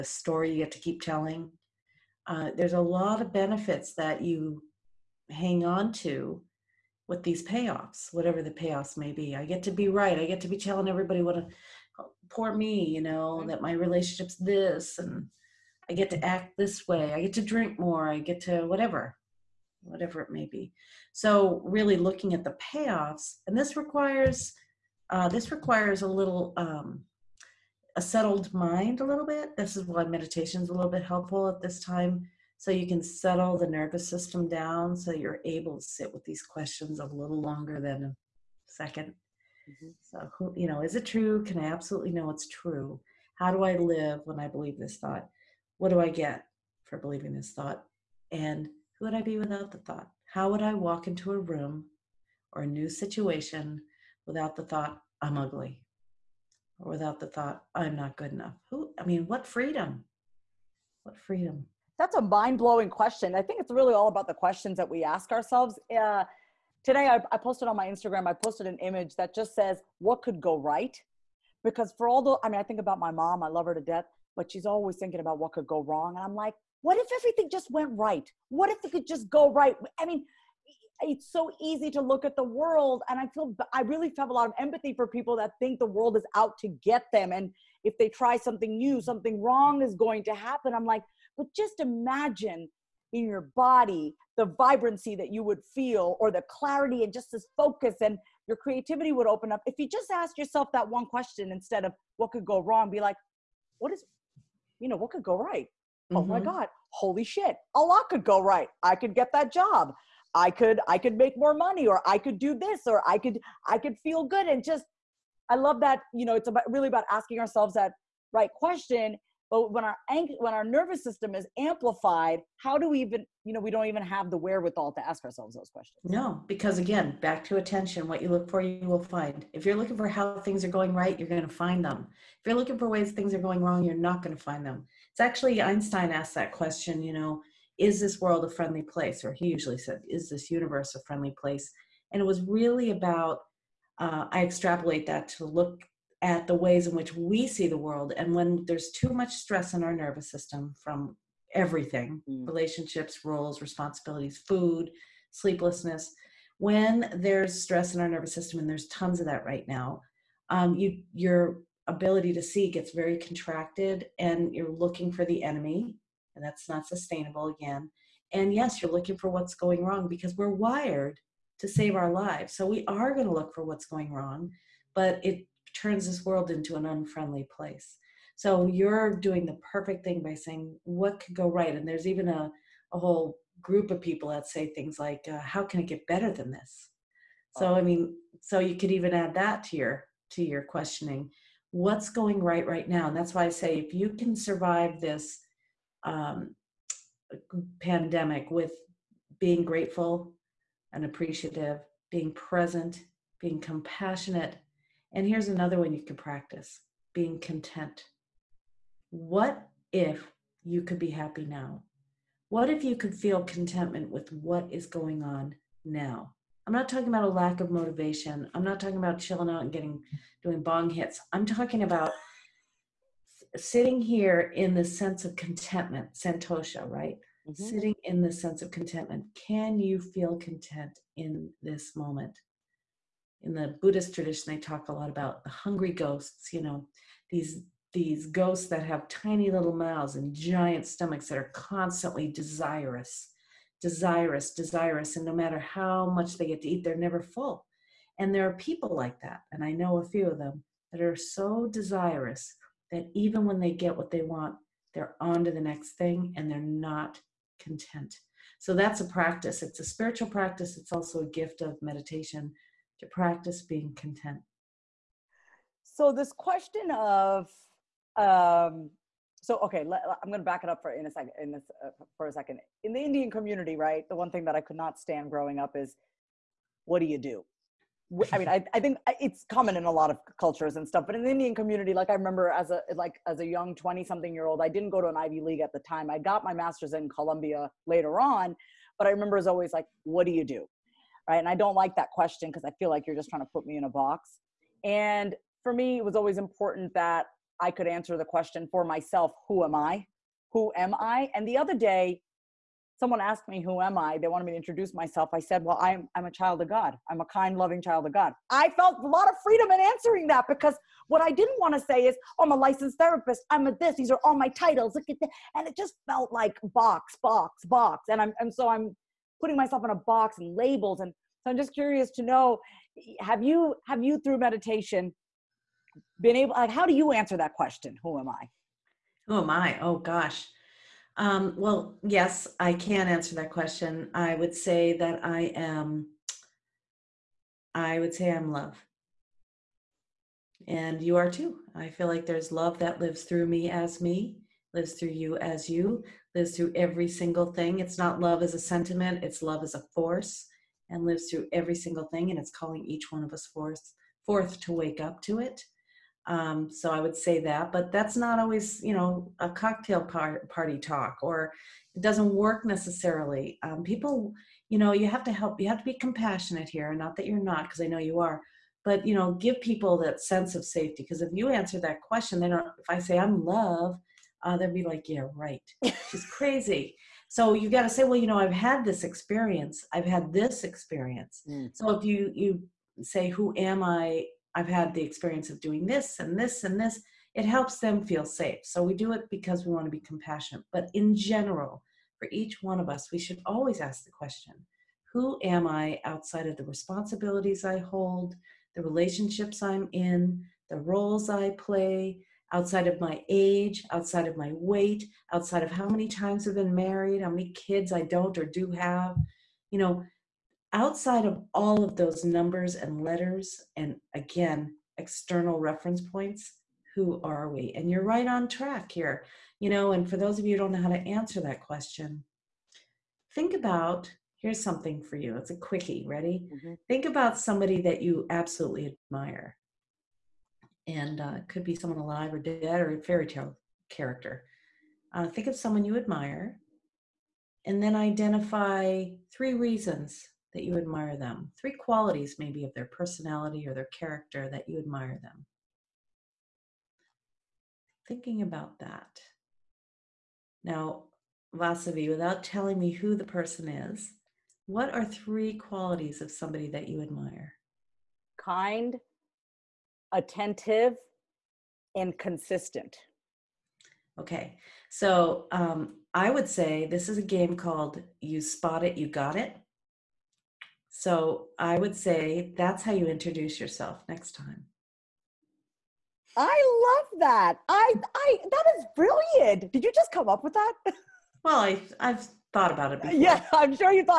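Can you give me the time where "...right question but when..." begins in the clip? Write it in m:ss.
1:58.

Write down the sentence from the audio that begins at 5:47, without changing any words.
It's not love as a sentiment, it's love as a force and lives through every single thing.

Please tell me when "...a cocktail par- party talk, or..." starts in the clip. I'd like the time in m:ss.
5:59.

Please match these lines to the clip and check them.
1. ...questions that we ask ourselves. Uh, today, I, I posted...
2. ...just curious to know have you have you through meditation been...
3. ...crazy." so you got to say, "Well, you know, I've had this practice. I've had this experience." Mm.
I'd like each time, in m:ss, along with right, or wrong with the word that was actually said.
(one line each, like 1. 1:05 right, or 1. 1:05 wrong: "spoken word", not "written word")
1. 1:04 right
2. 5:21 right
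3. 6:16 wrong: "experience", not "practice".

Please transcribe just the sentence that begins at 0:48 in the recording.
And who would I be without the thought?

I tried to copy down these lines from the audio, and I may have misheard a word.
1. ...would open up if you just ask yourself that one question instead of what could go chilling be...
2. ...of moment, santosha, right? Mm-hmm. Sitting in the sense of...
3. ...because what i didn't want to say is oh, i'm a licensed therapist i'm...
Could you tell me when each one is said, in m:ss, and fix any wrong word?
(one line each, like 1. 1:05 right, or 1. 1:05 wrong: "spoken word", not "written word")
1. 1:39 wrong: "wrong", not "chilling"
2. 3:45 wrong: "contentment", not "moment"
3. 5:10 right.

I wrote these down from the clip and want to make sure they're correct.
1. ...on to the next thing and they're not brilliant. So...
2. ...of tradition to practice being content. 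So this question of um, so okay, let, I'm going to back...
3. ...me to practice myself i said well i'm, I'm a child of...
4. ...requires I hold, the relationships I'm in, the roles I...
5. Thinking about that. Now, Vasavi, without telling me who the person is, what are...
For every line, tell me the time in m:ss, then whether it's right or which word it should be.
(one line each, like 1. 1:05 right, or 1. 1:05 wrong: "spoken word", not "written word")
1. 4:15 wrong: "content", not "brilliant"
2. 4:21 wrong: "meditation", not "tradition"
3. 5:04 wrong: "introduce", not "practice"
4. 6:36 wrong: "responsibilities", not "requires"
5. 7:28 right.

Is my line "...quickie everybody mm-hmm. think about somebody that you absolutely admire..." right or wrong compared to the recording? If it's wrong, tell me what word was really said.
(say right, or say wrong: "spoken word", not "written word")
wrong: "ready", not "everybody".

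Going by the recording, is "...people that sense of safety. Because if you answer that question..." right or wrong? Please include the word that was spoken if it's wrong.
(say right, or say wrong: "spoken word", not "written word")
right.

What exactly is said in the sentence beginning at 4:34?
The one thing that I could not stand growing up is, what do you do?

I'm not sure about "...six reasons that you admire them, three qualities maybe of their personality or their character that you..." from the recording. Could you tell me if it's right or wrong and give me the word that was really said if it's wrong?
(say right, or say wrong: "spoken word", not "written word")
wrong: "three", not "six".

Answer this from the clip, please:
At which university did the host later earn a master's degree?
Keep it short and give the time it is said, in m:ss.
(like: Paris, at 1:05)
Columbia, at 4:47.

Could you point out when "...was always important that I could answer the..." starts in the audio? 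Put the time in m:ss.
4:56.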